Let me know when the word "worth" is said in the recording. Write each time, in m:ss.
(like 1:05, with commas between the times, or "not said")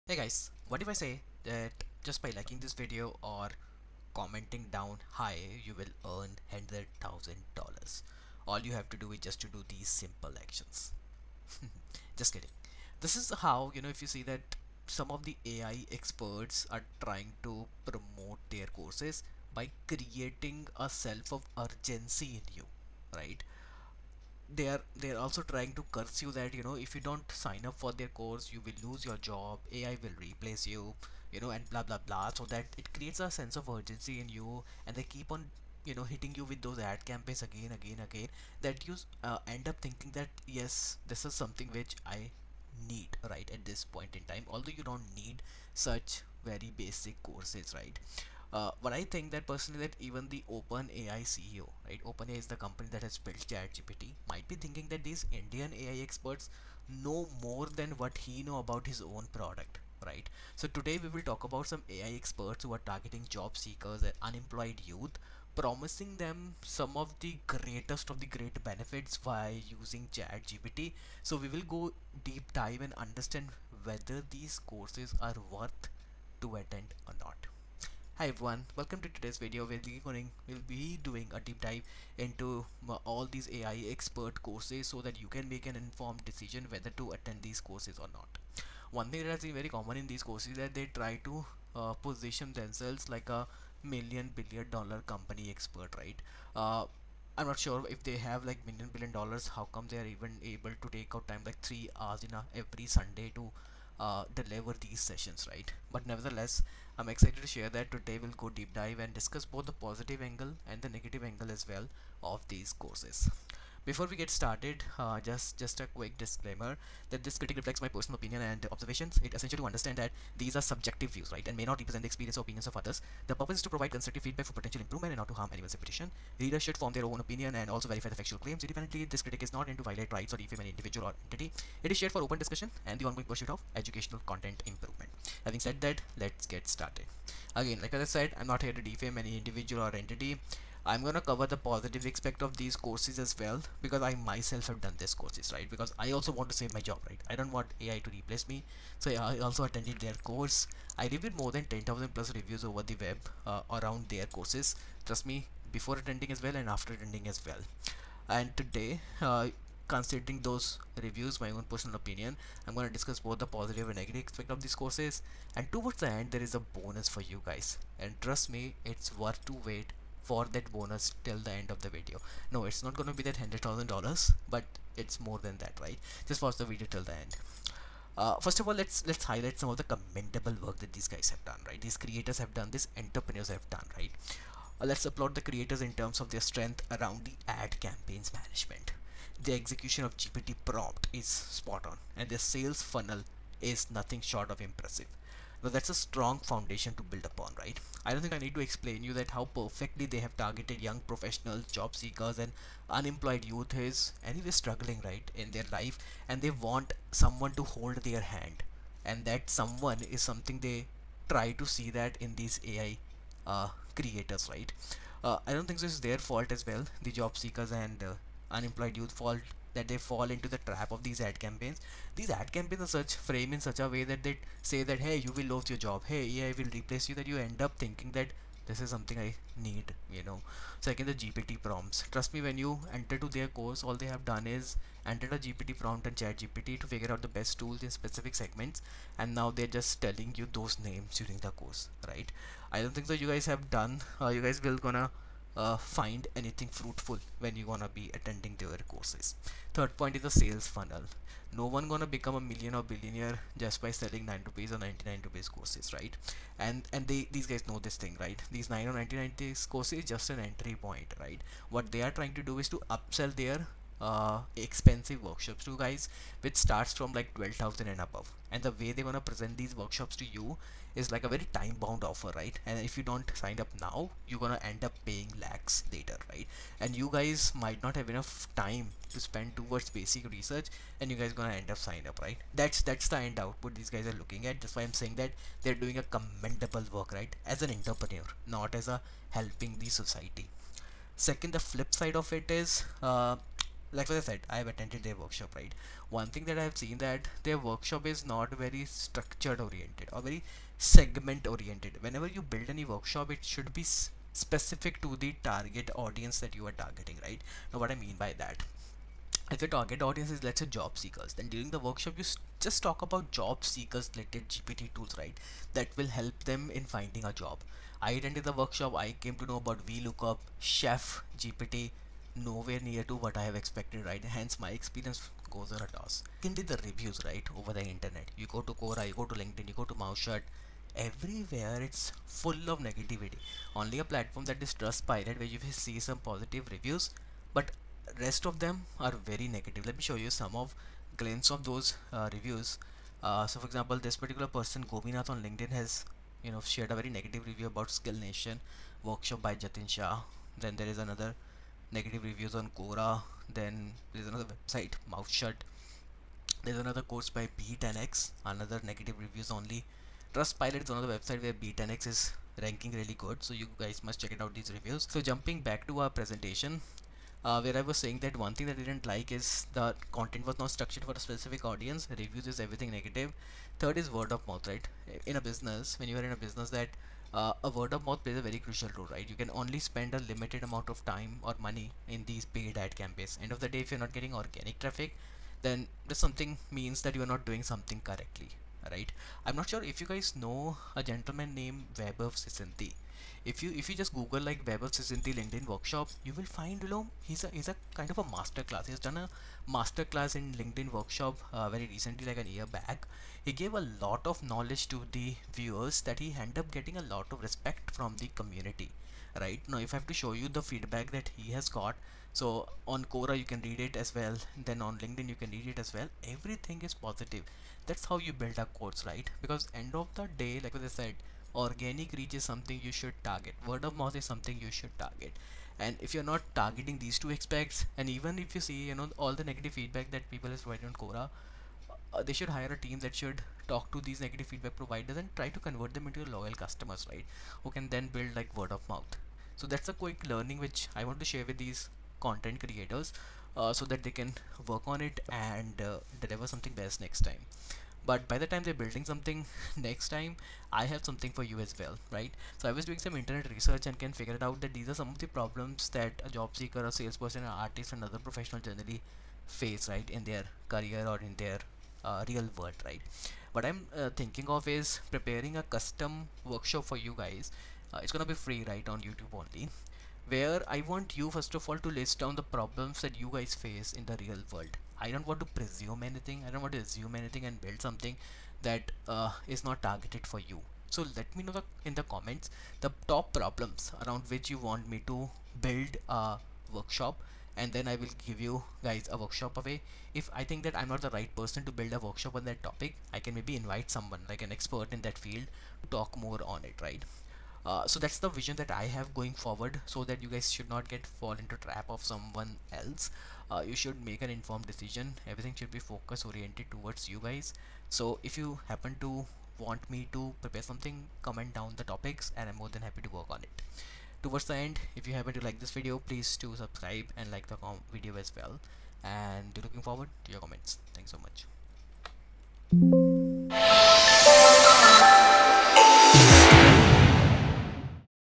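1:15, 2:49.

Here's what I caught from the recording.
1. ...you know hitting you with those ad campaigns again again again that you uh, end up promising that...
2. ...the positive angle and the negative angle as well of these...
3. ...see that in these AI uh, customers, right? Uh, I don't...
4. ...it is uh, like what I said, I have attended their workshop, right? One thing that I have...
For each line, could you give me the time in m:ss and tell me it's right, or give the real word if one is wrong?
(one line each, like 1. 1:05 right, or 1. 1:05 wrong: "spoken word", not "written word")
1. 0:35 wrong: "thinking", not "promising"
2. 1:49 right
3. 3:31 wrong: "creators", not "customers"
4. 4:52 right.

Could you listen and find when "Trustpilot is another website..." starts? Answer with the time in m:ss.
6:00.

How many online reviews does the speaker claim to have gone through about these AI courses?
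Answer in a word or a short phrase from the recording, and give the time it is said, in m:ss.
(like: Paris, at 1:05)
10,000 plus, at 2:31.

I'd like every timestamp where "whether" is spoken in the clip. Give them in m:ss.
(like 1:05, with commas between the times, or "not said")
1:13, 1:26.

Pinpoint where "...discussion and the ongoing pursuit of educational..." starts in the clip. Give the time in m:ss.
2:12.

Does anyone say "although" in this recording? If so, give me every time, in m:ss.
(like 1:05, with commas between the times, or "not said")
0:44.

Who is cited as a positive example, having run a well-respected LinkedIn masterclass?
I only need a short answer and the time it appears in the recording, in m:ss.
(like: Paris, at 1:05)
Vaibhav Sisinty, at 6:31.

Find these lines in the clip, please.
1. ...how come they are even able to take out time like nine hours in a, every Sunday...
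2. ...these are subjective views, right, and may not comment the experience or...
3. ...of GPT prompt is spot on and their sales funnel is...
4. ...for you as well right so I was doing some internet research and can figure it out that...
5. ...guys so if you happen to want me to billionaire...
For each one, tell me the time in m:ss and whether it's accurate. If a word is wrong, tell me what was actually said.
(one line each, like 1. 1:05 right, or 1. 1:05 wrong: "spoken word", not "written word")
1. 1:39 wrong: "three", not "nine"
2. 2:00 wrong: "represent", not "comment"
3. 3:10 right
4. 7:31 right
5. 8:27 wrong: "prepare", not "billionaire".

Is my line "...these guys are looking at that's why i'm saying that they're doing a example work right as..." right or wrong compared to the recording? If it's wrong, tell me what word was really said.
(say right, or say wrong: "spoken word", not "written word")
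wrong: "commendable", not "example".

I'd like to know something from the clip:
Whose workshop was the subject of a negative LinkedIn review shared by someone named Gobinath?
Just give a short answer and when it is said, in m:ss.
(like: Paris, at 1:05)
Jatin Shah, at 5:49.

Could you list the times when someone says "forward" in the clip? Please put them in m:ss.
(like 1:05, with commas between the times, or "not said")
8:19, 8:39.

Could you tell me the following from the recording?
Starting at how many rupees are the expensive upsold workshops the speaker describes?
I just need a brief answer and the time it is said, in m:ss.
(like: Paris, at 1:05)
12,000, at 4:27.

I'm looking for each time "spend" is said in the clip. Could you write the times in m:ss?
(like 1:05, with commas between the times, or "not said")
4:39, 6:19.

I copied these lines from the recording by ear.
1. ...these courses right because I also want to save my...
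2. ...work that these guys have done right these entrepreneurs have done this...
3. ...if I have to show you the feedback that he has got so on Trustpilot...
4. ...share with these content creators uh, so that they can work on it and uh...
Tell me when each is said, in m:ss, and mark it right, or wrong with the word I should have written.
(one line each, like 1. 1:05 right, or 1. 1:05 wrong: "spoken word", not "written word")
1. 2:24 right
2. 3:00 wrong: "creators", not "entrepreneurs"
3. 6:49 wrong: "Quora", not "Trustpilot"
4. 7:21 right.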